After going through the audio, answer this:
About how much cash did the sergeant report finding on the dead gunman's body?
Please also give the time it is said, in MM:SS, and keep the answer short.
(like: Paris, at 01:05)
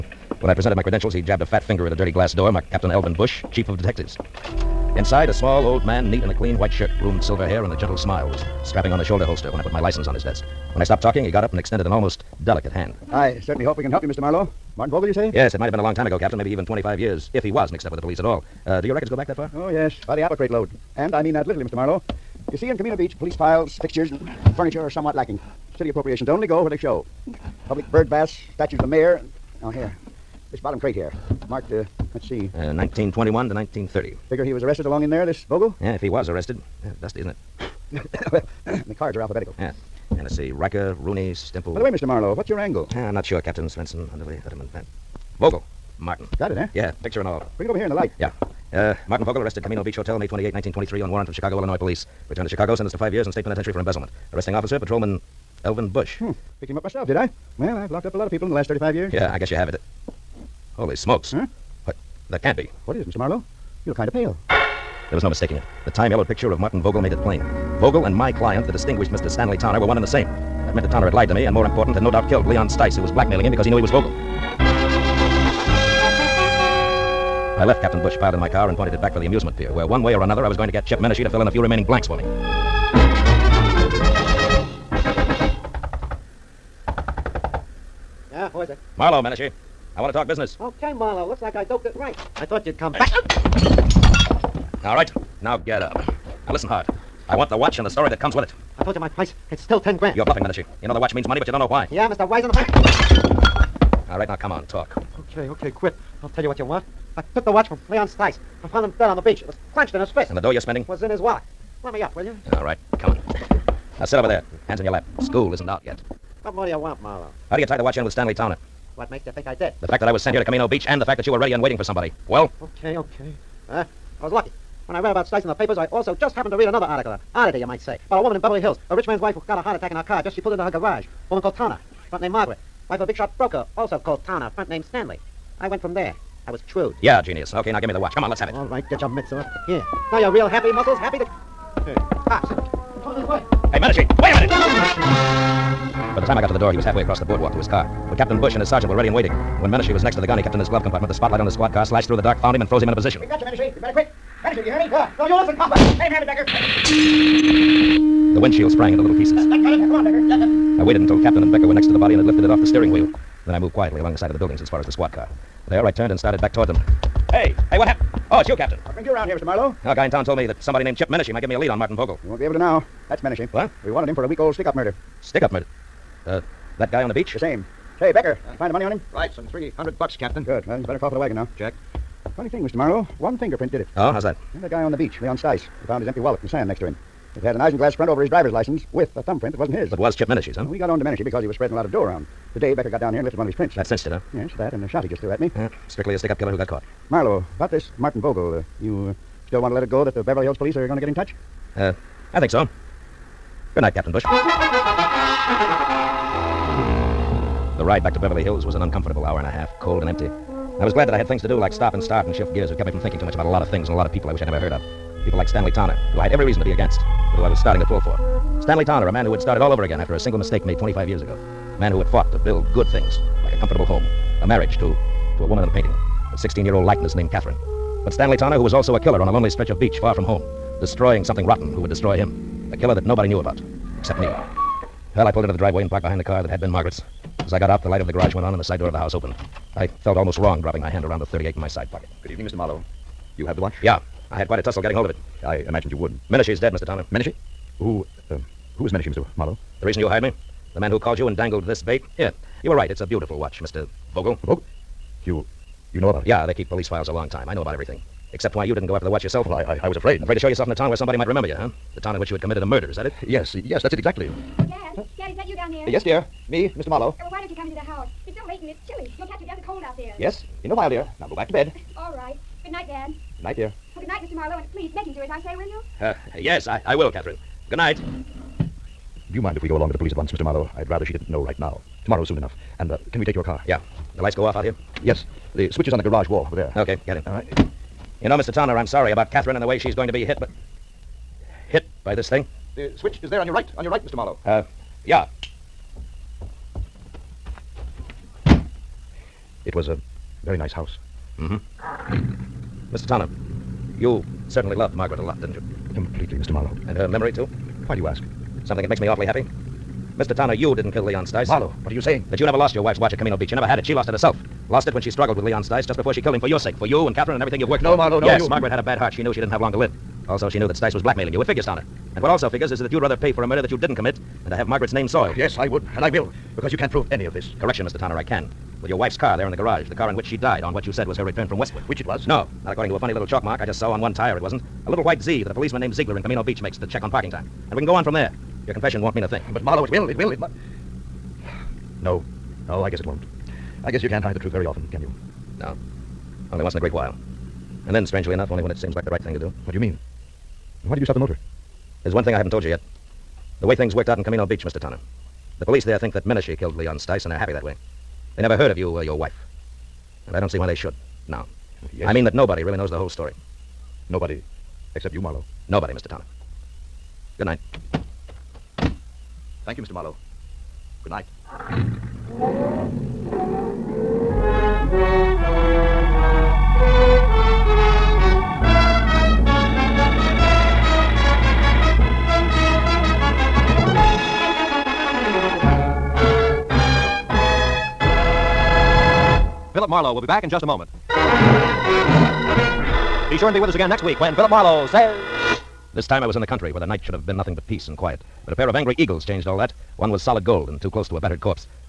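300 bucks, at 02:59.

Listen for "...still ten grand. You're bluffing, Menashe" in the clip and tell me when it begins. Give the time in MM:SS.
01:39.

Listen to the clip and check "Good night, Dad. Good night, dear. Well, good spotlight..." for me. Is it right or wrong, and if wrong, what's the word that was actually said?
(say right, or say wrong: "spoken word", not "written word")
wrong: "night", not "spotlight".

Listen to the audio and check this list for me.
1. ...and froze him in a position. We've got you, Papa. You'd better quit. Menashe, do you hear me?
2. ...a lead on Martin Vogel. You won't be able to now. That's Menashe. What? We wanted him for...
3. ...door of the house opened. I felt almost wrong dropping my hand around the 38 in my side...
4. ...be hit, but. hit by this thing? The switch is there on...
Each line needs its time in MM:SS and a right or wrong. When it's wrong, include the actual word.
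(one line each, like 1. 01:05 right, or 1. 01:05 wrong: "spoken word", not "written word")
1. 02:32 wrong: "Menashe", not "Papa"
2. 02:51 right
3. 03:58 right
4. 04:50 right.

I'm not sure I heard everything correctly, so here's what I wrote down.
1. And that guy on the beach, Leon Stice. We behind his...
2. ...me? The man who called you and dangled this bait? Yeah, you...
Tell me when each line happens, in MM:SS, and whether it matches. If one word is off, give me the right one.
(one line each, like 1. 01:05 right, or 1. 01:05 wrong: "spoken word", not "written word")
1. 03:04 wrong: "found", not "behind"
2. 04:10 right.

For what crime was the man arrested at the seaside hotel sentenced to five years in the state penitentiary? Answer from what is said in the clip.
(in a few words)
Embezzlement.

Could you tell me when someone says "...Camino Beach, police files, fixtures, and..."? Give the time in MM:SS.
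00:22.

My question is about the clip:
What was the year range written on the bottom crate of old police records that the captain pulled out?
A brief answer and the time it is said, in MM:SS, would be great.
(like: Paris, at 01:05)
1921 to 1930, at 00:32.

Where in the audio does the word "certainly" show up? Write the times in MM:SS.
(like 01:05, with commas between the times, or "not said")
00:13, 05:04.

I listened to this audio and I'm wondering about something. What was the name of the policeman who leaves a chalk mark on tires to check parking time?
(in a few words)
Ziegler.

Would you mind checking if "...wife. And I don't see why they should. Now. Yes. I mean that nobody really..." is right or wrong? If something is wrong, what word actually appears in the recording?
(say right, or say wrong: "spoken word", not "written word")
right.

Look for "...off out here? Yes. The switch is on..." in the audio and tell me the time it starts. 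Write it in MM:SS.
04:44.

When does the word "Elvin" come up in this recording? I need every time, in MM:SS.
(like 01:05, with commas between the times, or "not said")
00:02, 00:55.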